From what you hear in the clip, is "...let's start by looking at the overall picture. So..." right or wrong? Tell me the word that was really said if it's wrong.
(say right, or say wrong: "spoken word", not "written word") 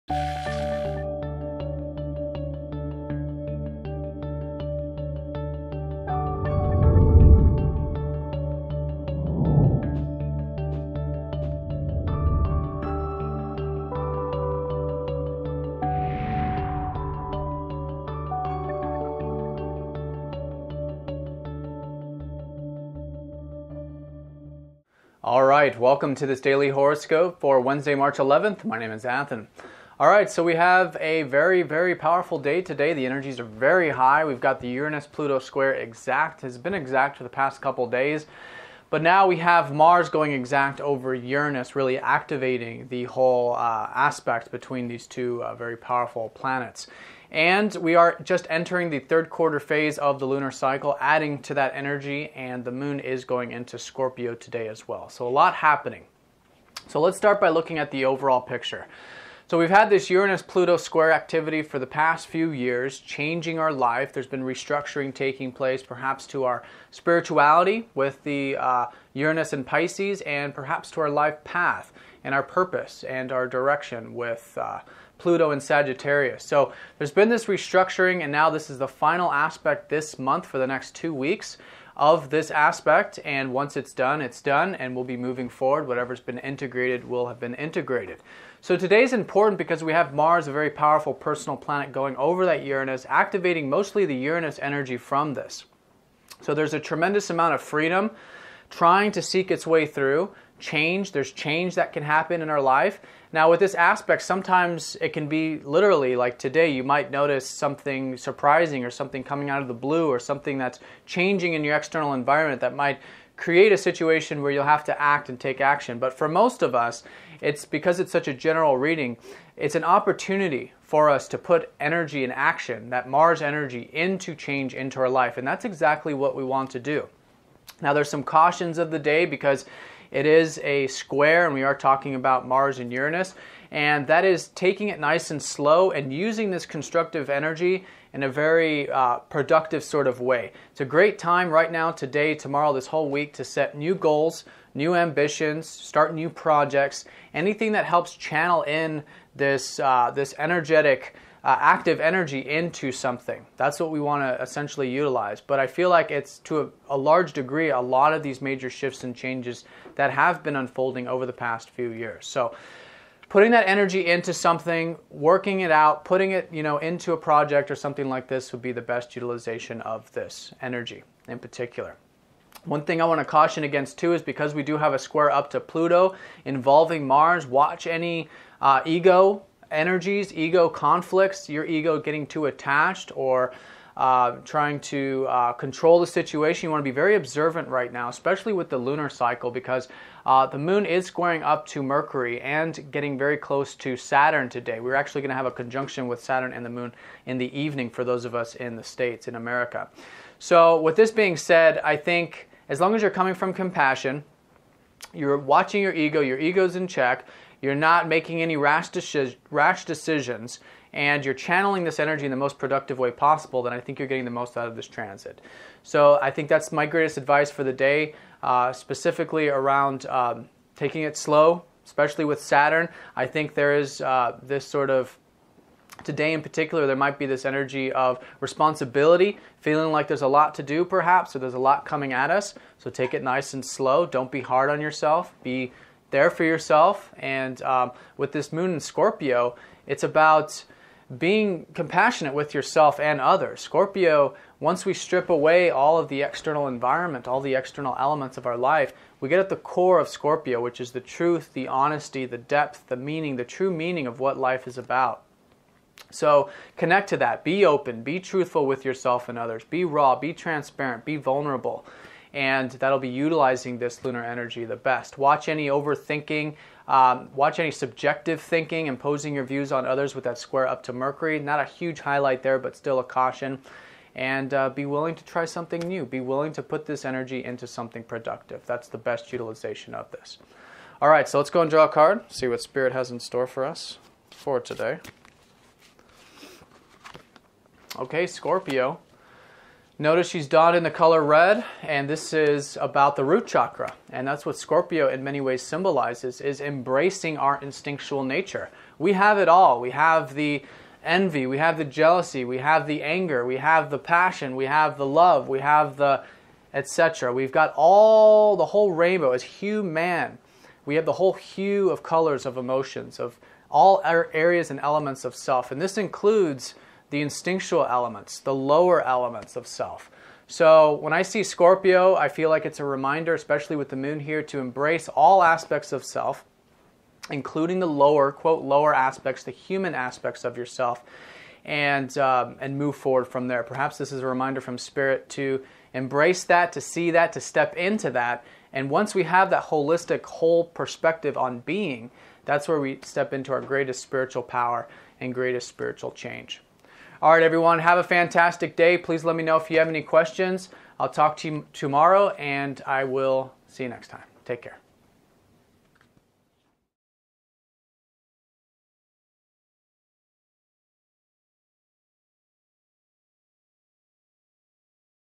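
right.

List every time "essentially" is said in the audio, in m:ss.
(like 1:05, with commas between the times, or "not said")
2:34.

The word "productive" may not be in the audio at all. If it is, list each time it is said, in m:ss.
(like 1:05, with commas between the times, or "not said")
2:19, 3:32, 4:38.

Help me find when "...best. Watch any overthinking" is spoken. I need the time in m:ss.
4:24.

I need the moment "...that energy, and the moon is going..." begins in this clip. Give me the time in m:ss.
0:51.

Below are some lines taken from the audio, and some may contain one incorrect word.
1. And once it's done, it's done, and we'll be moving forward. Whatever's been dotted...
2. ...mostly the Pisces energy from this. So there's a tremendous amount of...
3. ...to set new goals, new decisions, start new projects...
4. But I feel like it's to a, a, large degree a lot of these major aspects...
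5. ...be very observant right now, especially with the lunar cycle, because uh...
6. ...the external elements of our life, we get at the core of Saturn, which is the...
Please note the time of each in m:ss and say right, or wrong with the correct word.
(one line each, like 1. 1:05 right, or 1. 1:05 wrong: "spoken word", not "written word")
1. 1:23 wrong: "integrated", not "dotted"
2. 1:33 wrong: "Uranus", not "Pisces"
3. 2:23 wrong: "ambitions", not "decisions"
4. 2:35 wrong: "shifts", not "aspects"
5. 3:06 right
6. 4:07 wrong: "Scorpio", not "Saturn".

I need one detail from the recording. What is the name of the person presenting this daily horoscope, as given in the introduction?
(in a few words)
Athen.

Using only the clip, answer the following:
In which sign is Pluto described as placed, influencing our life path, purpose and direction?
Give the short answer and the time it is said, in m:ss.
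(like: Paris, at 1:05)
Sagittarius, at 1:15.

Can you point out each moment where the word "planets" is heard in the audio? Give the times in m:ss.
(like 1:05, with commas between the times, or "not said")
0:46, 1:31.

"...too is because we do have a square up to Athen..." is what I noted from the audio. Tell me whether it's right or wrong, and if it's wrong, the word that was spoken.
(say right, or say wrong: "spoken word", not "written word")
wrong: "Pluto", not "Athen".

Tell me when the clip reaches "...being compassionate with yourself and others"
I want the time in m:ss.
4:01.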